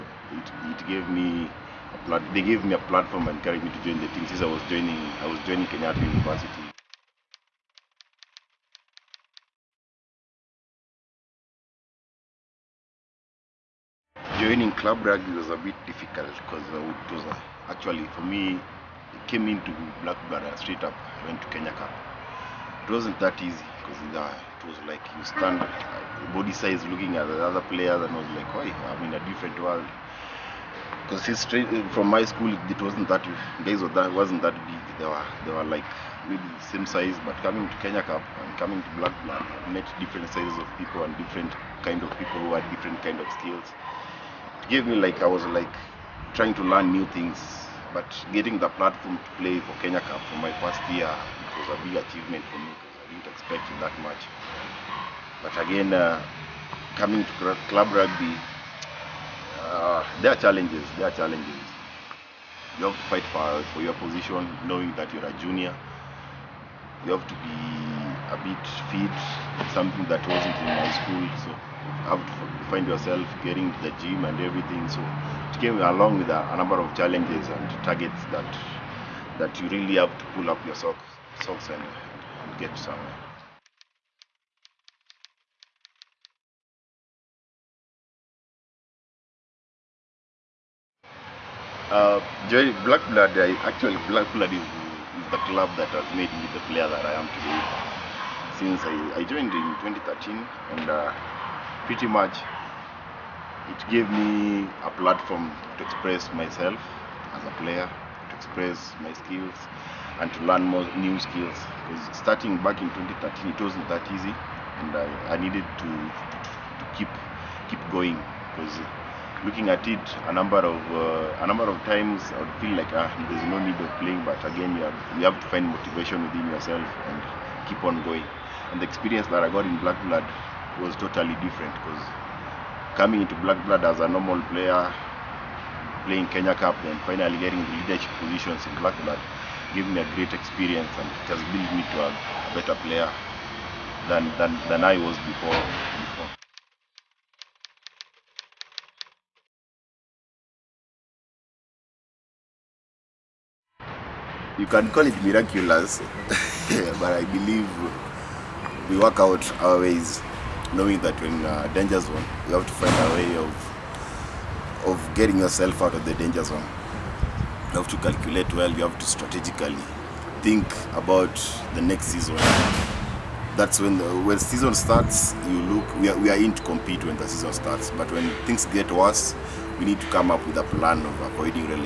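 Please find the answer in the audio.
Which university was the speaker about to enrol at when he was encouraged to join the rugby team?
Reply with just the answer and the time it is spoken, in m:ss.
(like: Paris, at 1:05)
Kenyatta University, at 0:05.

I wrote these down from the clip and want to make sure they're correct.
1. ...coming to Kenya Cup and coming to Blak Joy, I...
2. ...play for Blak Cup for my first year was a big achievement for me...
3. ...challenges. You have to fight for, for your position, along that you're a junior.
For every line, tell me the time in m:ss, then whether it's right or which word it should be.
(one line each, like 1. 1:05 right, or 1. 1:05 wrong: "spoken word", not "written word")
1. 0:37 wrong: "Blad", not "Joy"
2. 0:49 wrong: "Kenya", not "Blak"
3. 1:01 wrong: "knowing", not "along".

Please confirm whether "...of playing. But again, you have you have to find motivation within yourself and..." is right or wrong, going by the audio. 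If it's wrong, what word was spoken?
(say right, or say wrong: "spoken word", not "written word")
right.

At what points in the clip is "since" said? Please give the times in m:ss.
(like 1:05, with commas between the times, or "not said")
0:04, 1:38.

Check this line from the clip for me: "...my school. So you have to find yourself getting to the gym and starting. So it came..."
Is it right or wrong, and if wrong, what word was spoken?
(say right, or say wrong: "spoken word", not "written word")
wrong: "everything", not "starting".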